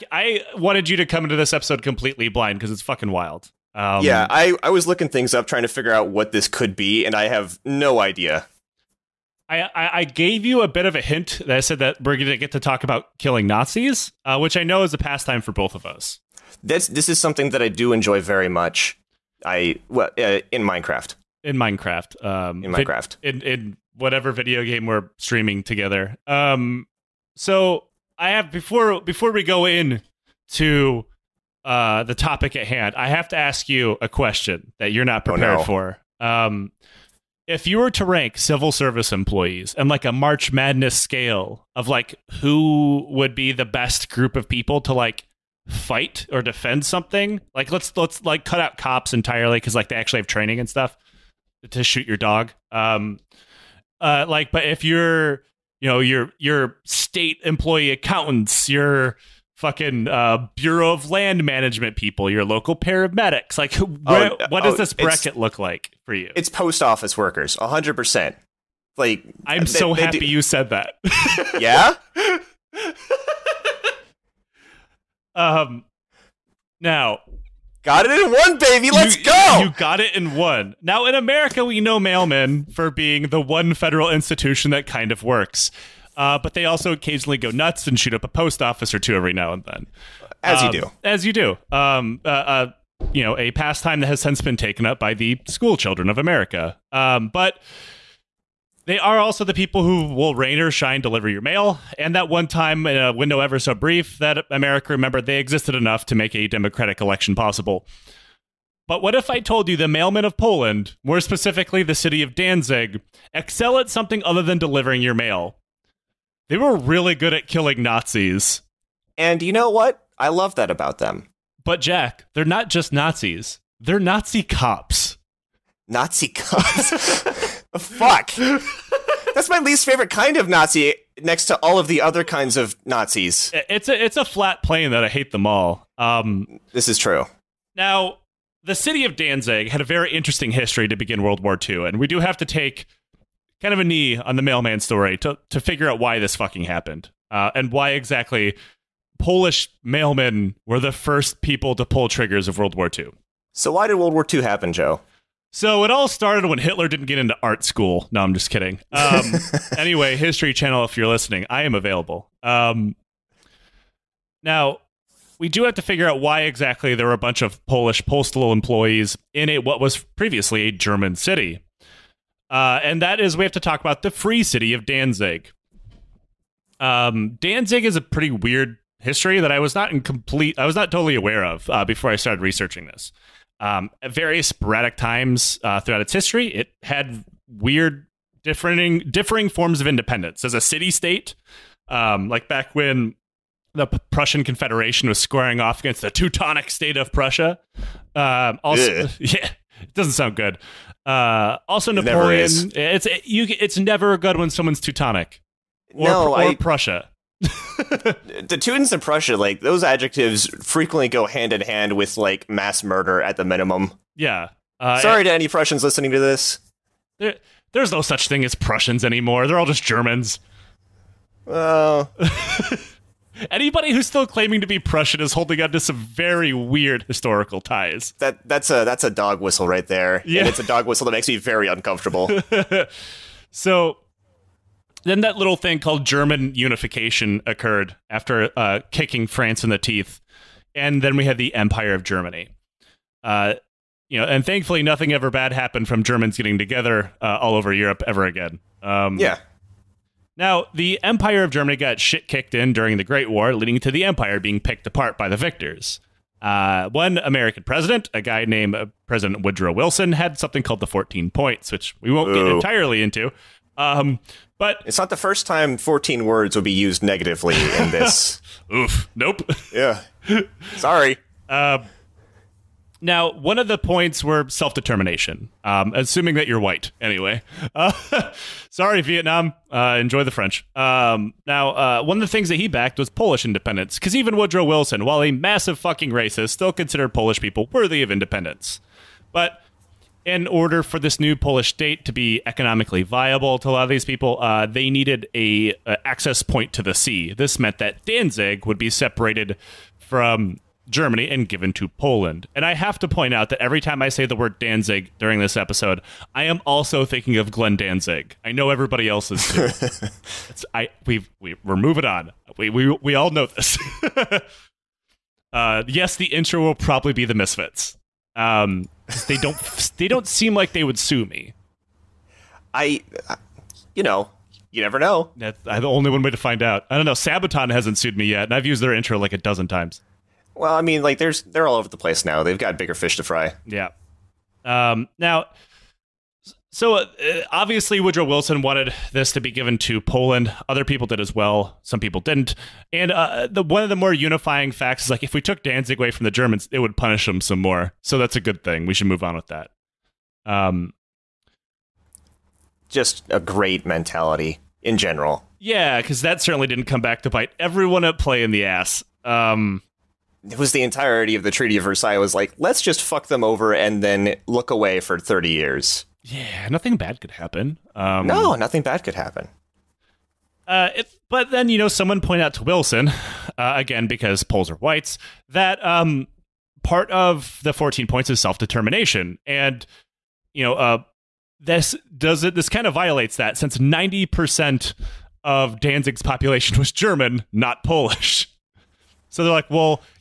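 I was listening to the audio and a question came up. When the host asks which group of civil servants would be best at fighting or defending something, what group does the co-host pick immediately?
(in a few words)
Post office workers.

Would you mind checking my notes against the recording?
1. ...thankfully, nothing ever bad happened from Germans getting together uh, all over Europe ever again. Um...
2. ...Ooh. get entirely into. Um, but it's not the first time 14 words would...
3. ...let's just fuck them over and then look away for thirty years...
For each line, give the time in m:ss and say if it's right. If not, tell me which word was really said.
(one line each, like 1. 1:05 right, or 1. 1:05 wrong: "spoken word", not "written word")
1. 4:04 right
2. 4:22 right
3. 6:02 right.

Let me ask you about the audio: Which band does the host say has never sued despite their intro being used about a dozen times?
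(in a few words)
Sabaton.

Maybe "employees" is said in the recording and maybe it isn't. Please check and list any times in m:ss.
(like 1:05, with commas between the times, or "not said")
0:39, 0:57, 2:48.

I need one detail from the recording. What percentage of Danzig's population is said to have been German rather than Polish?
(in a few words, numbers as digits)
90 percent.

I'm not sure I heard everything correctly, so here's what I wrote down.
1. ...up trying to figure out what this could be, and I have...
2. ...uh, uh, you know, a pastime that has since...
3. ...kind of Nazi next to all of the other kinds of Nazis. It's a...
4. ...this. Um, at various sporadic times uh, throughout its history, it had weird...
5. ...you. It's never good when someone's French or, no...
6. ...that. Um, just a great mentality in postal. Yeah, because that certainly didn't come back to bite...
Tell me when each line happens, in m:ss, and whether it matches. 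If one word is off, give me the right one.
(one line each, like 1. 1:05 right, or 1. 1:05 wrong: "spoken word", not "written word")
1. 0:05 right
2. 1:32 right
3. 2:10 right
4. 3:02 right
5. 3:23 wrong: "Teutonic", not "French"
6. 5:49 wrong: "general", not "postal".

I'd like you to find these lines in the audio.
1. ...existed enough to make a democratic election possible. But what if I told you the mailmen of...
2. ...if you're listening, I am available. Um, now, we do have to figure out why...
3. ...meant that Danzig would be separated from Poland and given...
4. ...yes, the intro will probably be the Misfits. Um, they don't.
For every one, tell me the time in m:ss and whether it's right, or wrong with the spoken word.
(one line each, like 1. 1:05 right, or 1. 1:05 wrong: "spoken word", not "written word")
1. 1:45 right
2. 2:40 right
3. 4:57 wrong: "Germany", not "Poland"
4. 5:15 right.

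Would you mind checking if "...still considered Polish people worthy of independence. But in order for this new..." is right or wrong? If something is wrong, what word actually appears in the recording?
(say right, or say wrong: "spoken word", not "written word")
right.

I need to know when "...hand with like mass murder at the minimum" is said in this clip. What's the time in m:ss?
3:31.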